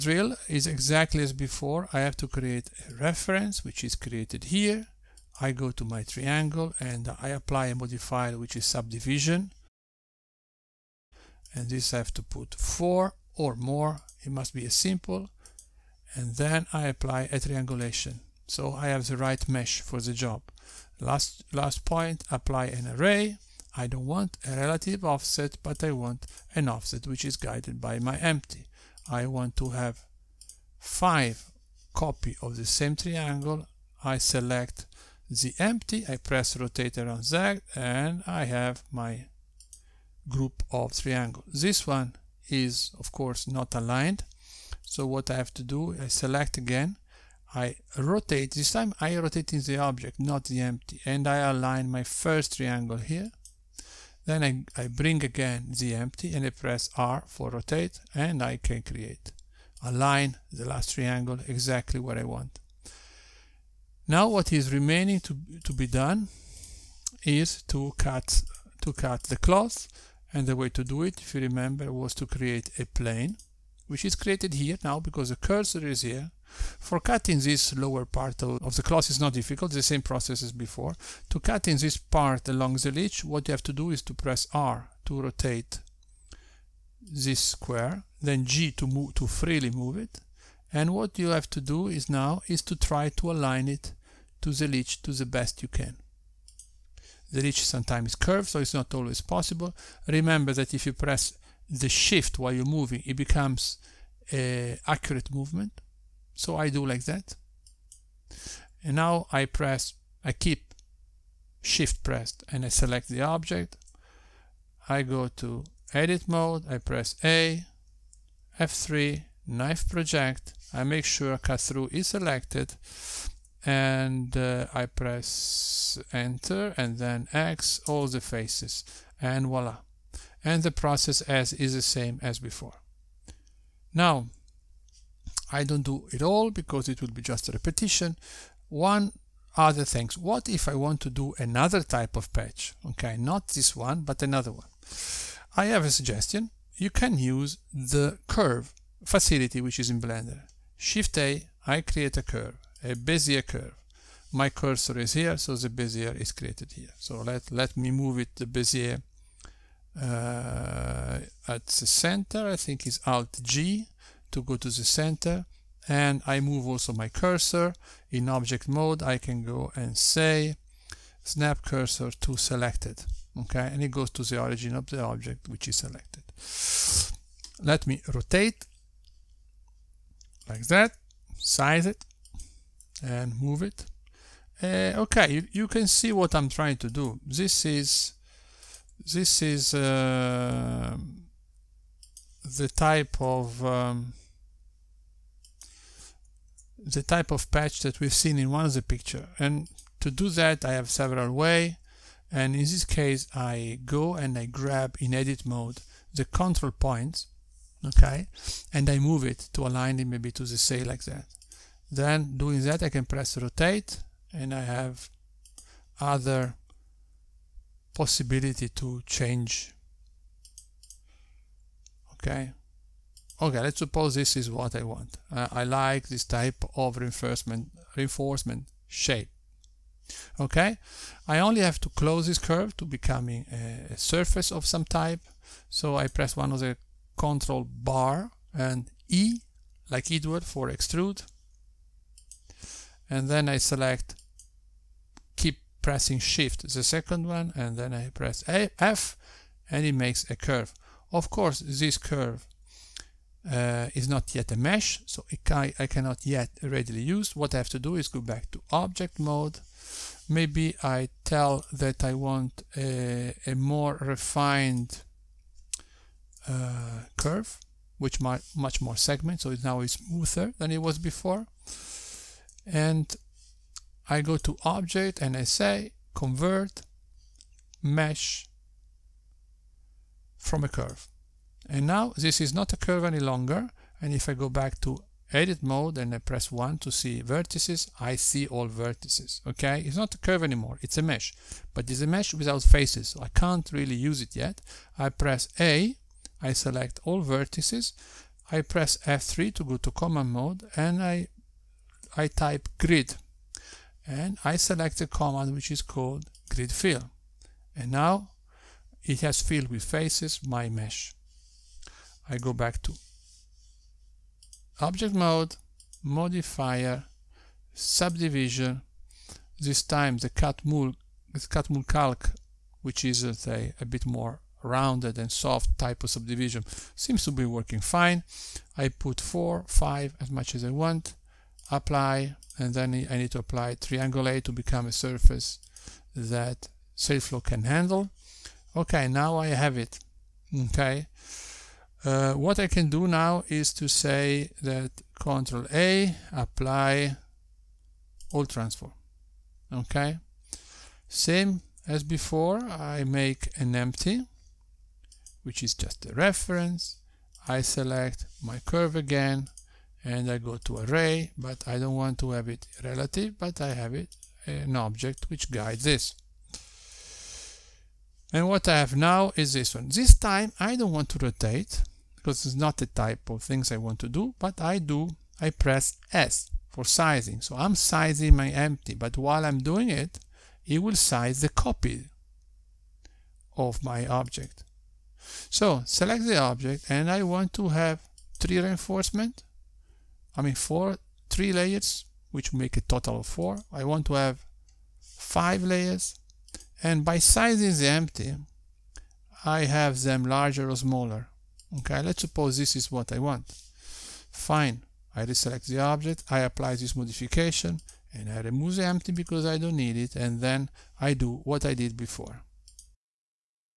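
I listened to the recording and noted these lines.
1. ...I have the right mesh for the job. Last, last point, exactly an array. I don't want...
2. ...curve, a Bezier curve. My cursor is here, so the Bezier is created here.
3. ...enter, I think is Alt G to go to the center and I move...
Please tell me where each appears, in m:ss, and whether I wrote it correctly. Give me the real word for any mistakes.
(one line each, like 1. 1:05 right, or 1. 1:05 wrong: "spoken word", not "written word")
1. 0:18 wrong: "apply", not "exactly"
2. 2:32 right
3. 2:41 wrong: "center", not "enter".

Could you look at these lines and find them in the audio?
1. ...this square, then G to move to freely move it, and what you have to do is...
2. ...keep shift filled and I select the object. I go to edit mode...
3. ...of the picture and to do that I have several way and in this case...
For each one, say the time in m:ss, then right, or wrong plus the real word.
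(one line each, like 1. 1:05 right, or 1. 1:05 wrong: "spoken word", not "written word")
1. 1:27 right
2. 1:50 wrong: "pressed", not "filled"
3. 3:18 right.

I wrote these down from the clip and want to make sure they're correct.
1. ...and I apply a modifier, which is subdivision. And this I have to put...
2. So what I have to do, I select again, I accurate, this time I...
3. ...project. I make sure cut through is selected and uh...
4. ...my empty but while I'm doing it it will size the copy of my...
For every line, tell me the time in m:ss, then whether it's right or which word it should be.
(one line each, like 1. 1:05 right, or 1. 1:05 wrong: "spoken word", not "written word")
1. 0:06 right
2. 0:44 wrong: "rotate", not "accurate"
3. 1:59 right
4. 6:18 right.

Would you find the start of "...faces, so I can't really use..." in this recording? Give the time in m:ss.
4:52.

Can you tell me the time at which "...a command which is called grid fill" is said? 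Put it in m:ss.
5:05.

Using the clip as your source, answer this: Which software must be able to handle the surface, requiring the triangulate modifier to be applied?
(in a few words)
SailFlow.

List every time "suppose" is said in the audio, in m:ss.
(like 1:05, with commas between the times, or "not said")
3:43, 6:42.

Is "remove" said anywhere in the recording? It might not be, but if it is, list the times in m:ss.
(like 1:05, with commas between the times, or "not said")
6:48.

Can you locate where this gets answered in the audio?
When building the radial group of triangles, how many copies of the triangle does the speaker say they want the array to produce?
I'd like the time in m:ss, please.
0:30.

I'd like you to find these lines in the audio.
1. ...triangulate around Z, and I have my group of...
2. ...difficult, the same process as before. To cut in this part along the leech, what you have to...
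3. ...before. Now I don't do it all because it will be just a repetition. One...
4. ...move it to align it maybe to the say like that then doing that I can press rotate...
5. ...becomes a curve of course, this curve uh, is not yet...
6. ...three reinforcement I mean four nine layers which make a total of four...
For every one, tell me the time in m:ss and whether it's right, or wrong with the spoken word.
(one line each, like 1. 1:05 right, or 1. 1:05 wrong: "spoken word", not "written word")
1. 0:36 wrong: "rotate", not "triangulate"
2. 1:19 right
3. 2:12 right
4. 3:28 right
5. 4:09 wrong: "makes", not "becomes"
6. 6:28 wrong: "three", not "nine".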